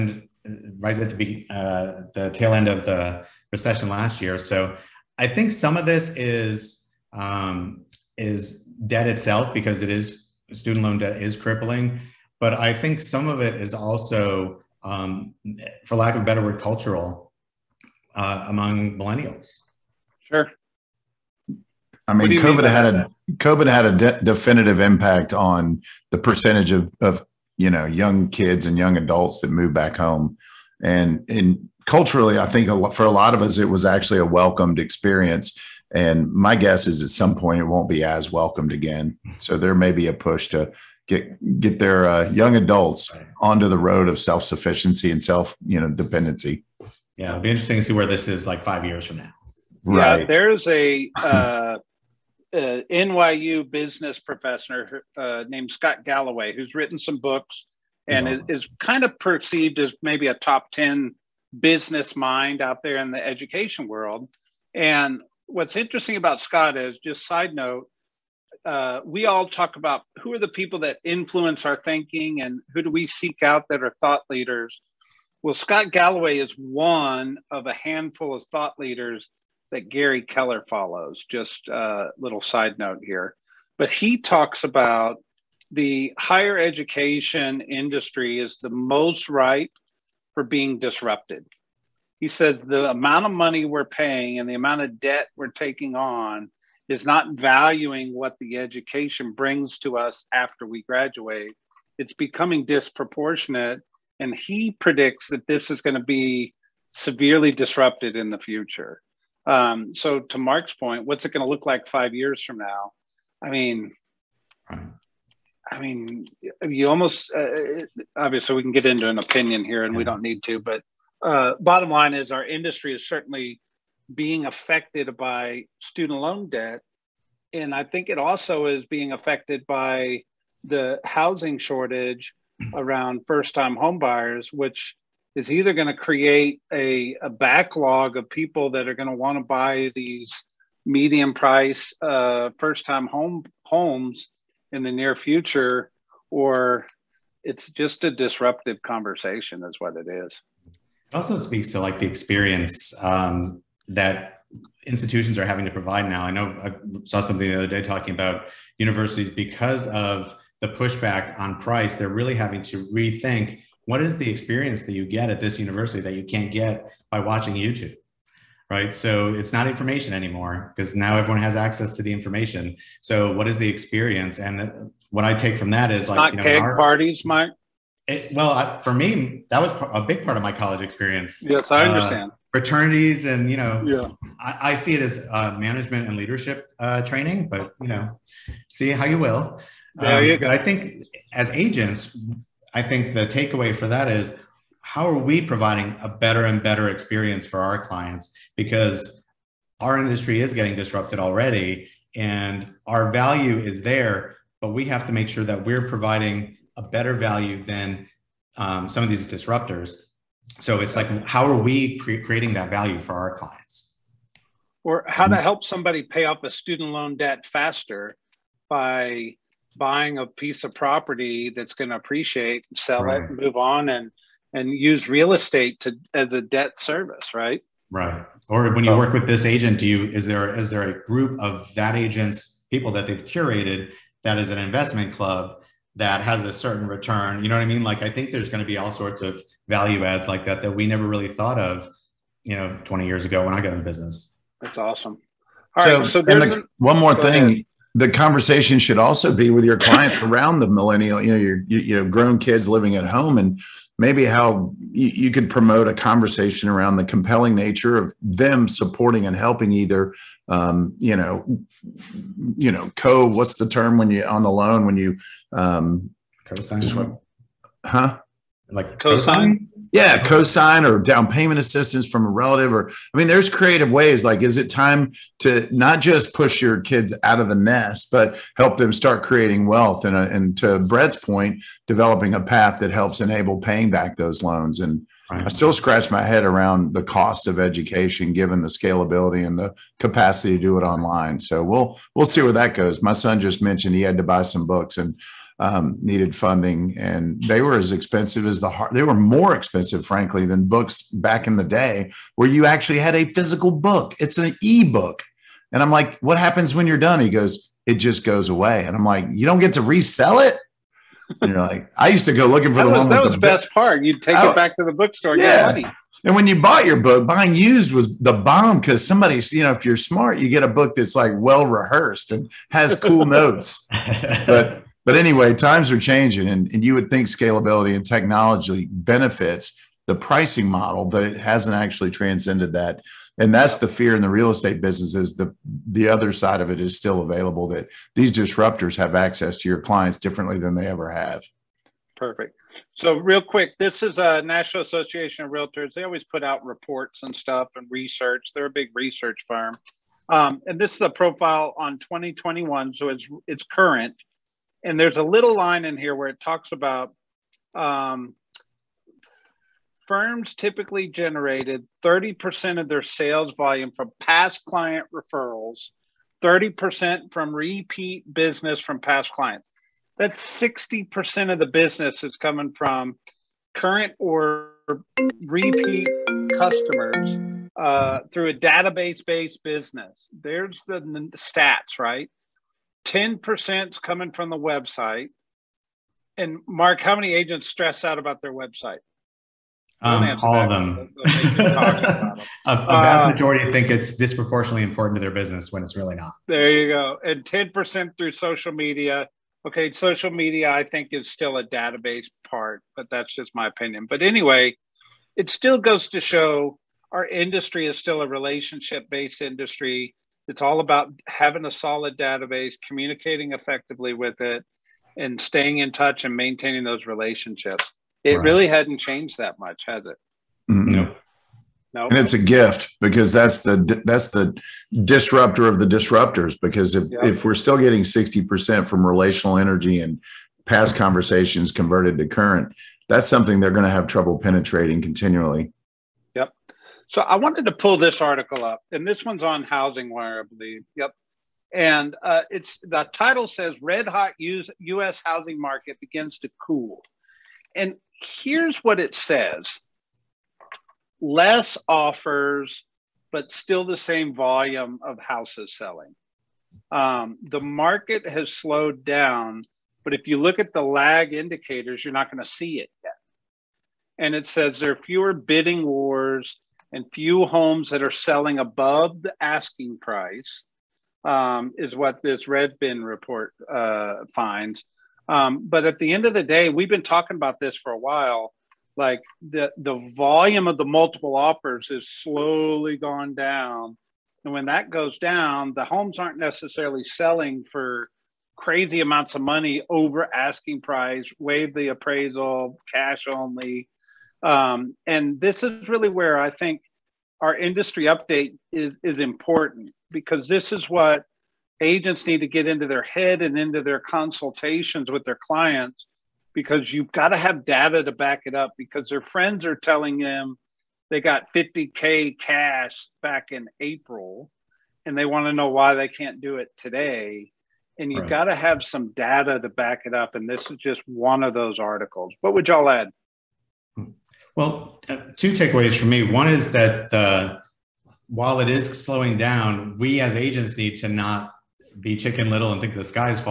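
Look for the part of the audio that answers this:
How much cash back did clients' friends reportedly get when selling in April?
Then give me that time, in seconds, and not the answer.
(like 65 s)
511 s.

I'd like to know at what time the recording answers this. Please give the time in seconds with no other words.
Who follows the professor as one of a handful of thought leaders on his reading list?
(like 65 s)
79 s.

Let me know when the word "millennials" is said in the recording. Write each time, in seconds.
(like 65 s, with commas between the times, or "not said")
18 s, 250 s.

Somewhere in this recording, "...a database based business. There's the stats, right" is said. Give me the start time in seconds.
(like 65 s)
378 s.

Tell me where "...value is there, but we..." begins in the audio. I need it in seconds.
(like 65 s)
203 s.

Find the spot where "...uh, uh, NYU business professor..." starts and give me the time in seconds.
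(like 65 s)
51 s.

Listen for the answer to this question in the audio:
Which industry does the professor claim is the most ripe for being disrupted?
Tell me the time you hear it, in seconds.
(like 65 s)
86 s.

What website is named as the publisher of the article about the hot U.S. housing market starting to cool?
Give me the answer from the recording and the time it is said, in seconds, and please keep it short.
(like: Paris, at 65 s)
Housing Wire, at 439 s.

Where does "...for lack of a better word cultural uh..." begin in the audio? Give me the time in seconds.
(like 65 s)
15 s.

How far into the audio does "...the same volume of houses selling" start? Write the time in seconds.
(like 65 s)
453 s.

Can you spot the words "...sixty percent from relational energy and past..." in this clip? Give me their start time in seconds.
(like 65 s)
428 s.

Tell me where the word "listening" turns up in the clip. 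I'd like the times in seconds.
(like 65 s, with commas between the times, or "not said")
not said.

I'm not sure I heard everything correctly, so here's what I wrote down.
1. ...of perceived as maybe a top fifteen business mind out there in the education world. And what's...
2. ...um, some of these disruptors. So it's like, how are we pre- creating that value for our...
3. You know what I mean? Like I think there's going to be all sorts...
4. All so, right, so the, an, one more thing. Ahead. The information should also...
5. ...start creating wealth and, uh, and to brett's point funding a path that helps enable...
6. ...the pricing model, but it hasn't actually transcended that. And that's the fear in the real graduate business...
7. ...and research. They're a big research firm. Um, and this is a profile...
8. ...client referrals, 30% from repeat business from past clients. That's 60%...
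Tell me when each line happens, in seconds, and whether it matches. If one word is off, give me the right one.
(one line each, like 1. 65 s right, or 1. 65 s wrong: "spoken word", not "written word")
1. 59 s wrong: "ten", not "fifteen"
2. 208 s right
3. 237 s right
4. 245 s wrong: "conversation", not "information"
5. 278 s wrong: "developing", not "funding"
6. 330 s wrong: "estate", not "graduate"
7. 347 s right
8. 364 s right.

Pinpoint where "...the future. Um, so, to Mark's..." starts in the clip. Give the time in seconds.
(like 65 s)
108 s.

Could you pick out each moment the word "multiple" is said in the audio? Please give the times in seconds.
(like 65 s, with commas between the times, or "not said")
480 s.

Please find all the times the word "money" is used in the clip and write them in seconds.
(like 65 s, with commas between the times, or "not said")
93 s, 489 s.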